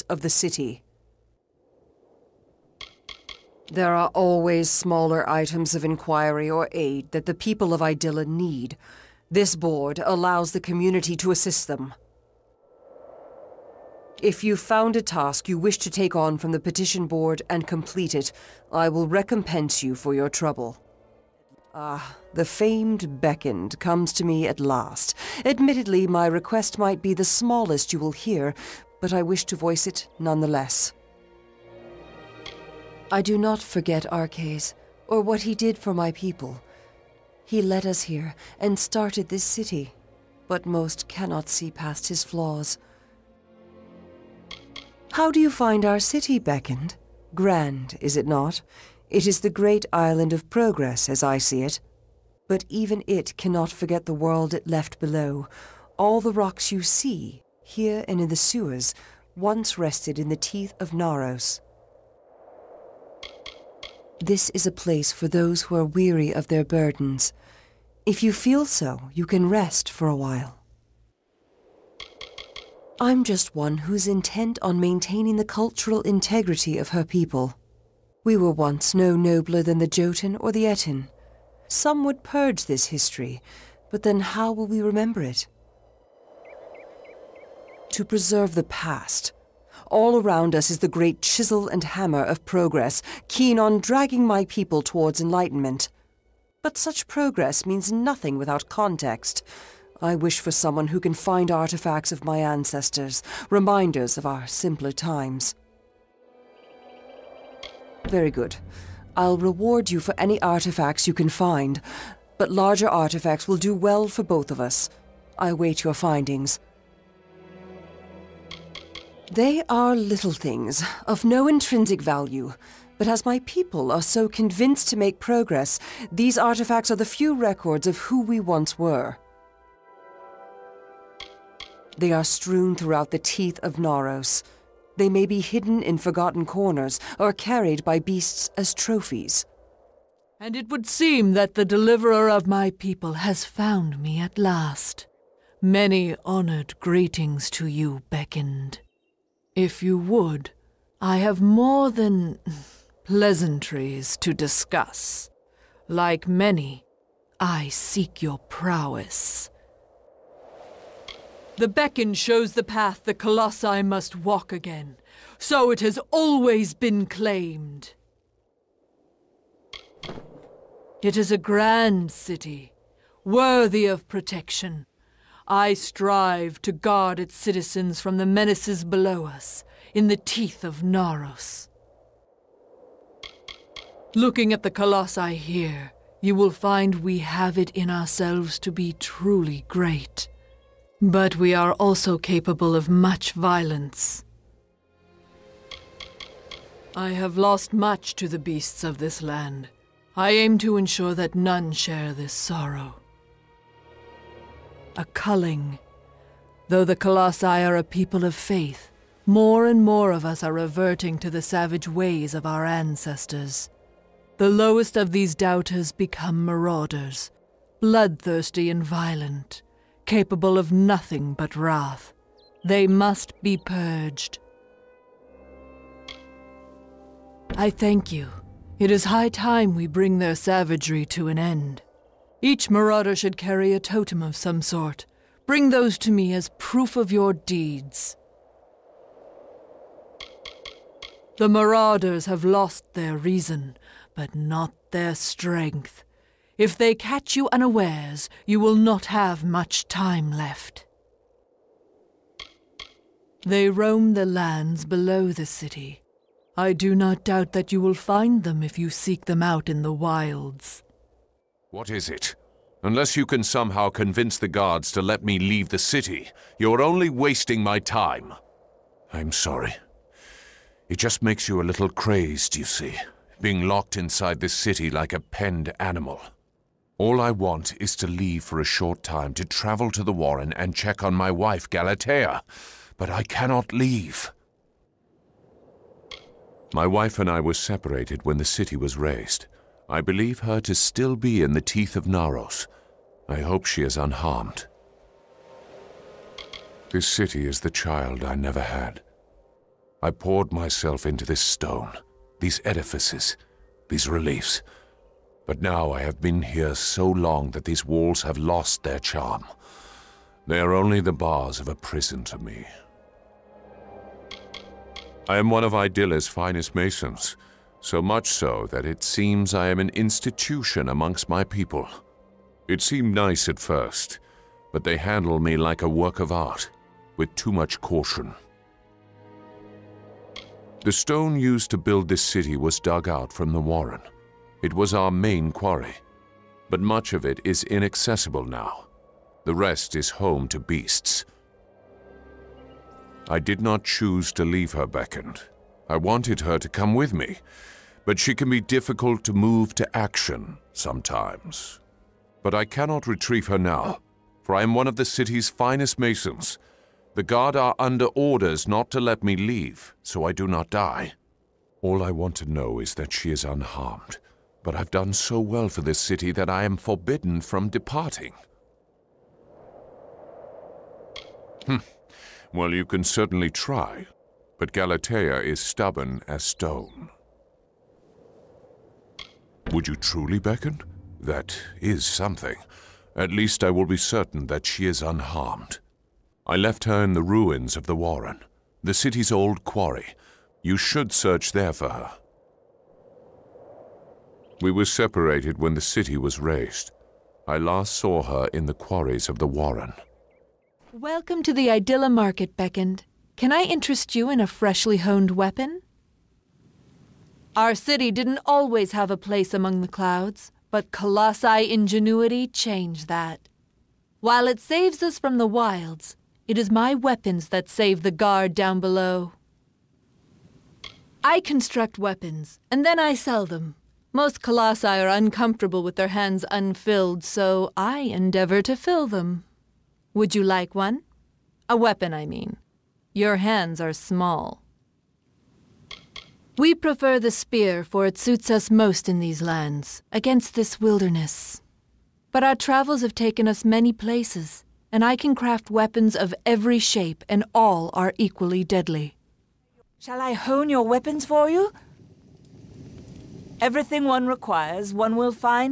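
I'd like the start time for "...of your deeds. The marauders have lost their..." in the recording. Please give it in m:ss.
3:56.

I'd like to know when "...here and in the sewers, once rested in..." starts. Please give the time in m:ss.
0:57.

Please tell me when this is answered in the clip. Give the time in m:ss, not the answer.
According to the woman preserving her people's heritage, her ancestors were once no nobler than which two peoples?
1:19.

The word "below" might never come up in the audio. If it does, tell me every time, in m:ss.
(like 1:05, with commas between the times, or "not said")
0:54, 2:58, 4:14, 6:58.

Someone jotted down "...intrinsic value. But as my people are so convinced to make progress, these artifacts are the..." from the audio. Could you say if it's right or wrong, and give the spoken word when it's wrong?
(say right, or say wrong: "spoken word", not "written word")
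right.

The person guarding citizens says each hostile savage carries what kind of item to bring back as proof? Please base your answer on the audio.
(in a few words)
A totem.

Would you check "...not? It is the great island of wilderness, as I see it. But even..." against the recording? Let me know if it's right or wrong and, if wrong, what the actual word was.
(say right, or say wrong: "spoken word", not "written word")
wrong: "progress", not "wilderness".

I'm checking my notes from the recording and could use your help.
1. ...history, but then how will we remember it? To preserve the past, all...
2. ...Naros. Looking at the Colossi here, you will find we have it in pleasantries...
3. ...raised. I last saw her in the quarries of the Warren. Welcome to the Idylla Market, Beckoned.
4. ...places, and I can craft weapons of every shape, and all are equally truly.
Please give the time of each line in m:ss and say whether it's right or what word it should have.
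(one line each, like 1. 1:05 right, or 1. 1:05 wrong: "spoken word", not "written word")
1. 1:22 right
2. 3:00 wrong: "ourselves", not "pleasantries"
3. 6:36 right
4. 7:23 wrong: "deadly", not "truly".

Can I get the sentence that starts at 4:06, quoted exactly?
If they catch you unawares, you will not have much time left.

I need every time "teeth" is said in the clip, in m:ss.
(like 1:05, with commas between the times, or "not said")
1:00, 2:13, 3:00, 4:51.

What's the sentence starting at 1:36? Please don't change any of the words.
But such progress means nothing without context.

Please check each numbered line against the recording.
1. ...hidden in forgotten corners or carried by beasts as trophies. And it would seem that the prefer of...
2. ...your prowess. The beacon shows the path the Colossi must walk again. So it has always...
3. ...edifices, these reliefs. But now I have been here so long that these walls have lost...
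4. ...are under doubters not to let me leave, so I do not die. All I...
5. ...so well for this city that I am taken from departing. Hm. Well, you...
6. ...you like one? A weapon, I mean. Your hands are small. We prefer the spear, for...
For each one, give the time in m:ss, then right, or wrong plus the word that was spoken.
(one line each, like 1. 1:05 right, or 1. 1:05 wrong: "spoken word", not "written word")
1. 2:15 wrong: "deliverer", not "prefer"
2. 2:38 right
3. 5:02 right
4. 5:57 wrong: "orders", not "doubters"
5. 6:05 wrong: "forbidden", not "taken"
6. 7:10 right.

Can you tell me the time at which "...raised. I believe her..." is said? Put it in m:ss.
4:48.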